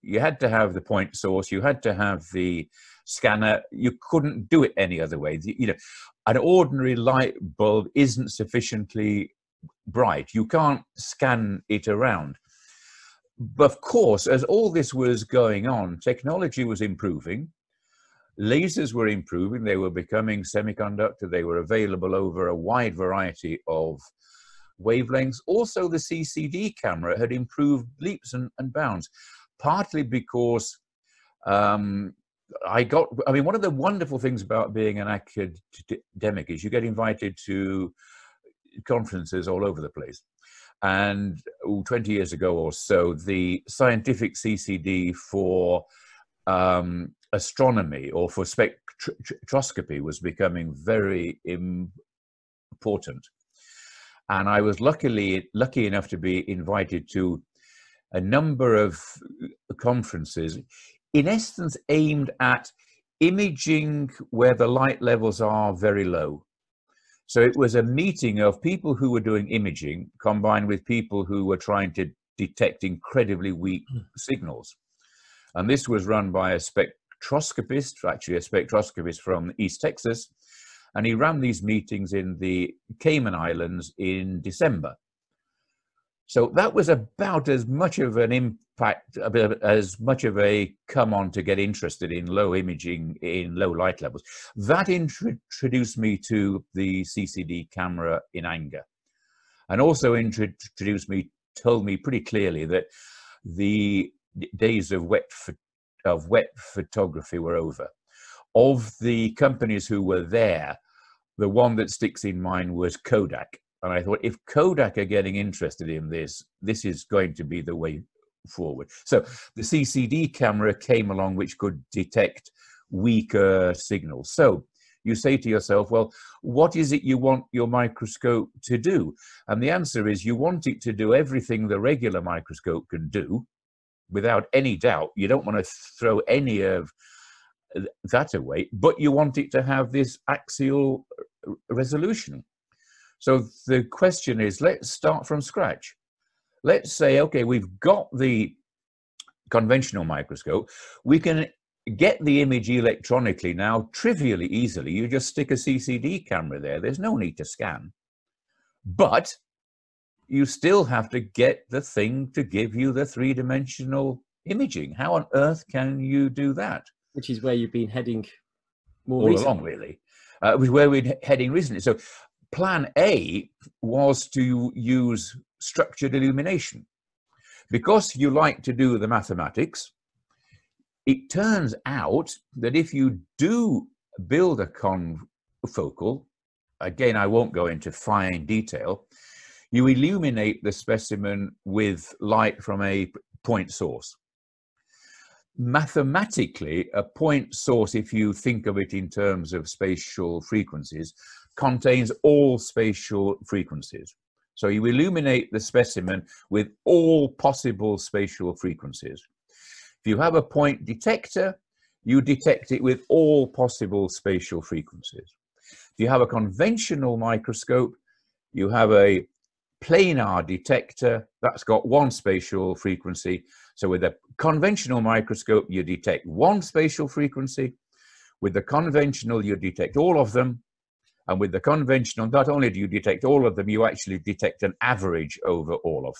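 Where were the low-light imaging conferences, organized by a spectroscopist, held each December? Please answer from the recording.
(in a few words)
Cayman Islands.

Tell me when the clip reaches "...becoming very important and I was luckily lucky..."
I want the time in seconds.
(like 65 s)
50 s.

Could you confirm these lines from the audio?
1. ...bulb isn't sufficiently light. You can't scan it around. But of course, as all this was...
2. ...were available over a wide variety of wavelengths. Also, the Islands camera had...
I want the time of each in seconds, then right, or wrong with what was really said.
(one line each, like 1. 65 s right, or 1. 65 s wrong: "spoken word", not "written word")
1. 7 s wrong: "bright", not "light"
2. 21 s wrong: "CCD", not "Islands".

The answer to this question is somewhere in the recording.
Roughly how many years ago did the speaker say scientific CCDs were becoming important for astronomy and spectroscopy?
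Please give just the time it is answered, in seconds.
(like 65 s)
41 s.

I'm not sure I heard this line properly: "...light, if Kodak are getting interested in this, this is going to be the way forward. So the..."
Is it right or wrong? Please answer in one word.
wrong.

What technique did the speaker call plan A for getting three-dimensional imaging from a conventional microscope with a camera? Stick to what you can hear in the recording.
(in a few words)
Structured illumination.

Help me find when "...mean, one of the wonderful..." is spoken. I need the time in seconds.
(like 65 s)
33 s.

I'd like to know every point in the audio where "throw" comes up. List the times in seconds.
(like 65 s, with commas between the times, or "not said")
135 s.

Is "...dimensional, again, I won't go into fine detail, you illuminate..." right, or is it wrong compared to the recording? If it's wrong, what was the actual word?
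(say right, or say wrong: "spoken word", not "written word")
wrong: "confocal", not "dimensional".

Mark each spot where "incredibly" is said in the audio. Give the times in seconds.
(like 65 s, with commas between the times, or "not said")
72 s.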